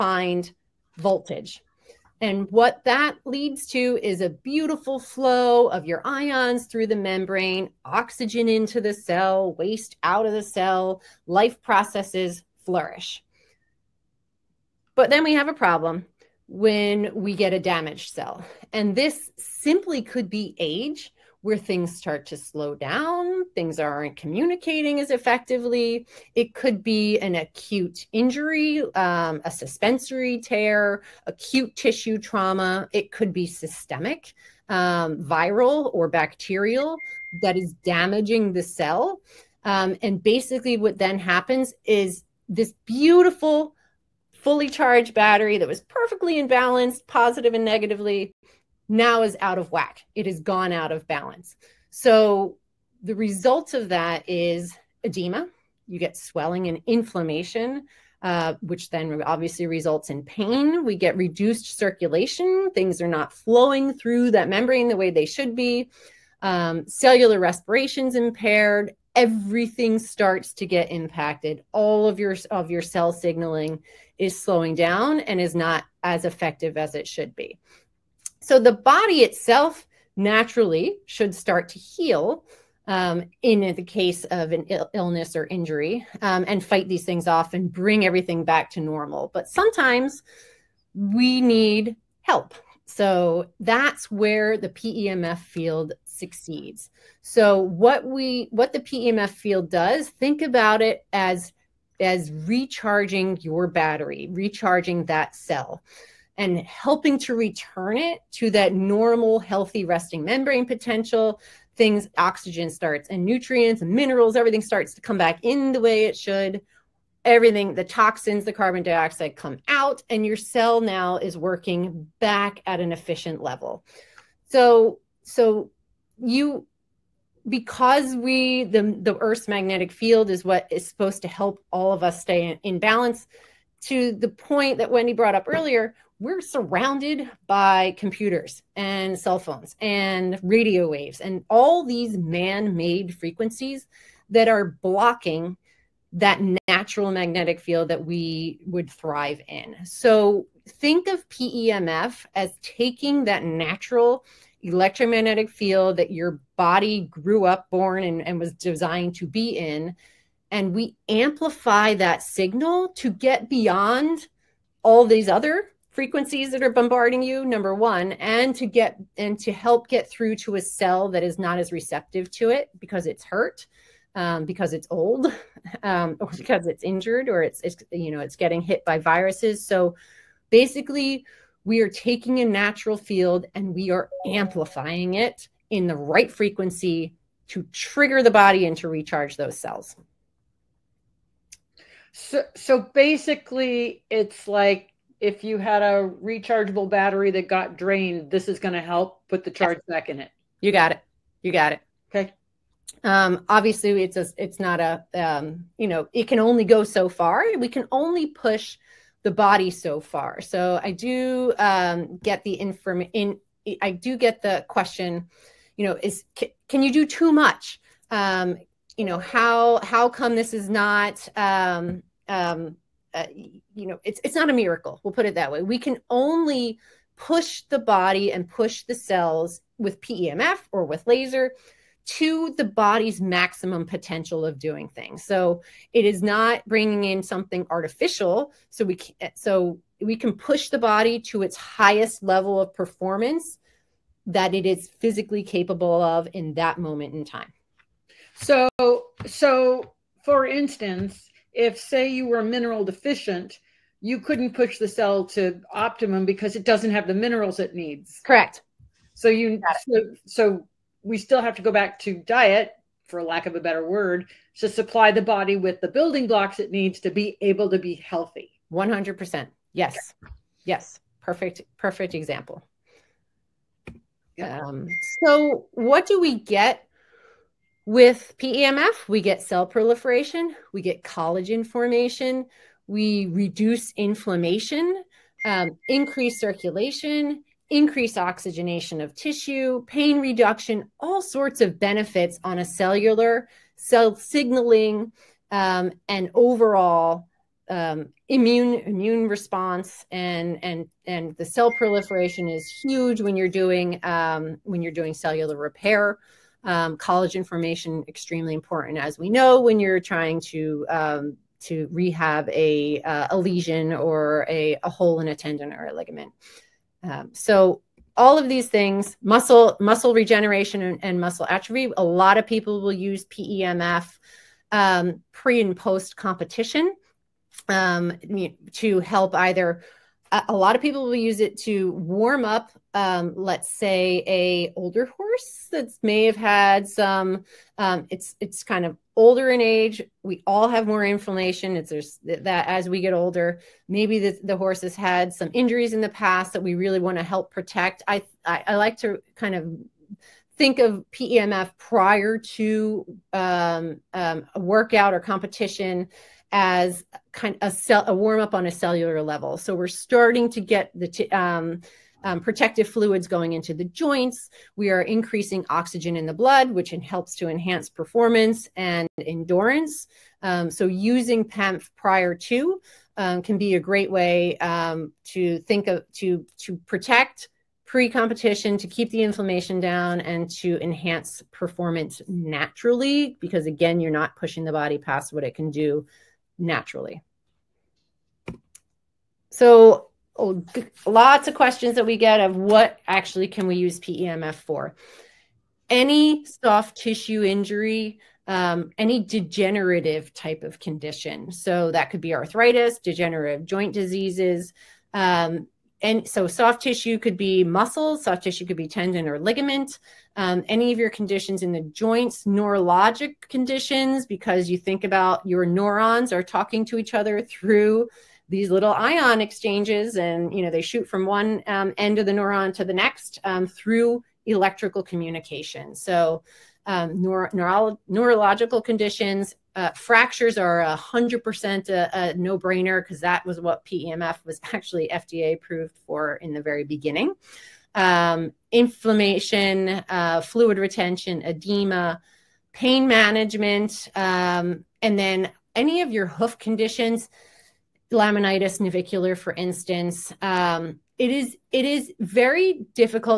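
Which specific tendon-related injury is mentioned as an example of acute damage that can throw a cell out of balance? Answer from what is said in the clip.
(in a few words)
suspensory tear.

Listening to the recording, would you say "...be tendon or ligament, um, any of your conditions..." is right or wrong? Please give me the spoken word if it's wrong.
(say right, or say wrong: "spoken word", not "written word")
right.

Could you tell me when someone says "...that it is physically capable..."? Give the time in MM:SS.
04:04.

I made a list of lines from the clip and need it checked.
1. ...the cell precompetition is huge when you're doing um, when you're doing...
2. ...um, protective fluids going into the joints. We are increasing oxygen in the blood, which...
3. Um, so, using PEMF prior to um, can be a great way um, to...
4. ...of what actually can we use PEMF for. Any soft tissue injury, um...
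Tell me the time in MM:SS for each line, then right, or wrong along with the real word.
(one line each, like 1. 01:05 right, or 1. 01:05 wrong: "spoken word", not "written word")
1. 05:01 wrong: "proliferation", not "precompetition"
2. 06:02 right
3. 06:10 right
4. 06:32 right.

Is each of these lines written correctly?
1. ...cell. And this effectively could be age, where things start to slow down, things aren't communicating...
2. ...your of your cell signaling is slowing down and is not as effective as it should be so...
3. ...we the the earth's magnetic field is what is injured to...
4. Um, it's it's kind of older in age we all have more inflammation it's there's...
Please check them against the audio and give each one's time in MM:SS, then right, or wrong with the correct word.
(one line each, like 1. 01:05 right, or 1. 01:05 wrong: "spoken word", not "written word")
1. 00:18 wrong: "simply", not "effectively"
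2. 01:12 right
3. 02:08 wrong: "supposed", not "injured"
4. 05:37 right.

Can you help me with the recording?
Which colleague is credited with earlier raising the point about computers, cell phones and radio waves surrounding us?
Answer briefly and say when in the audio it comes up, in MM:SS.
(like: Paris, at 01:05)
Wendy, at 02:14.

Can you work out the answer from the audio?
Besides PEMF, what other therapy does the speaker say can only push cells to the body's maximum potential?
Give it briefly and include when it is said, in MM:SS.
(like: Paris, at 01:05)
laser, at 03:51.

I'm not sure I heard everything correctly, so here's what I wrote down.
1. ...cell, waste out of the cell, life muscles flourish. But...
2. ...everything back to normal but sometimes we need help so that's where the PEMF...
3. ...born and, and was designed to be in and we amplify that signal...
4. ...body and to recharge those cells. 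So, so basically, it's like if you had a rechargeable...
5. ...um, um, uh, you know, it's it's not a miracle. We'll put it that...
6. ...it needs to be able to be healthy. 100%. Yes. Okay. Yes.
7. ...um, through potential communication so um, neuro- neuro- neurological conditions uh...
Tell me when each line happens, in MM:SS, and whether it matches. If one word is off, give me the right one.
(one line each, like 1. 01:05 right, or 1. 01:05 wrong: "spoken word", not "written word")
1. 00:08 wrong: "processes", not "muscles"
2. 01:28 right
3. 02:37 right
4. 03:08 right
5. 03:41 right
6. 04:26 right
7. 07:03 wrong: "electrical", not "potential".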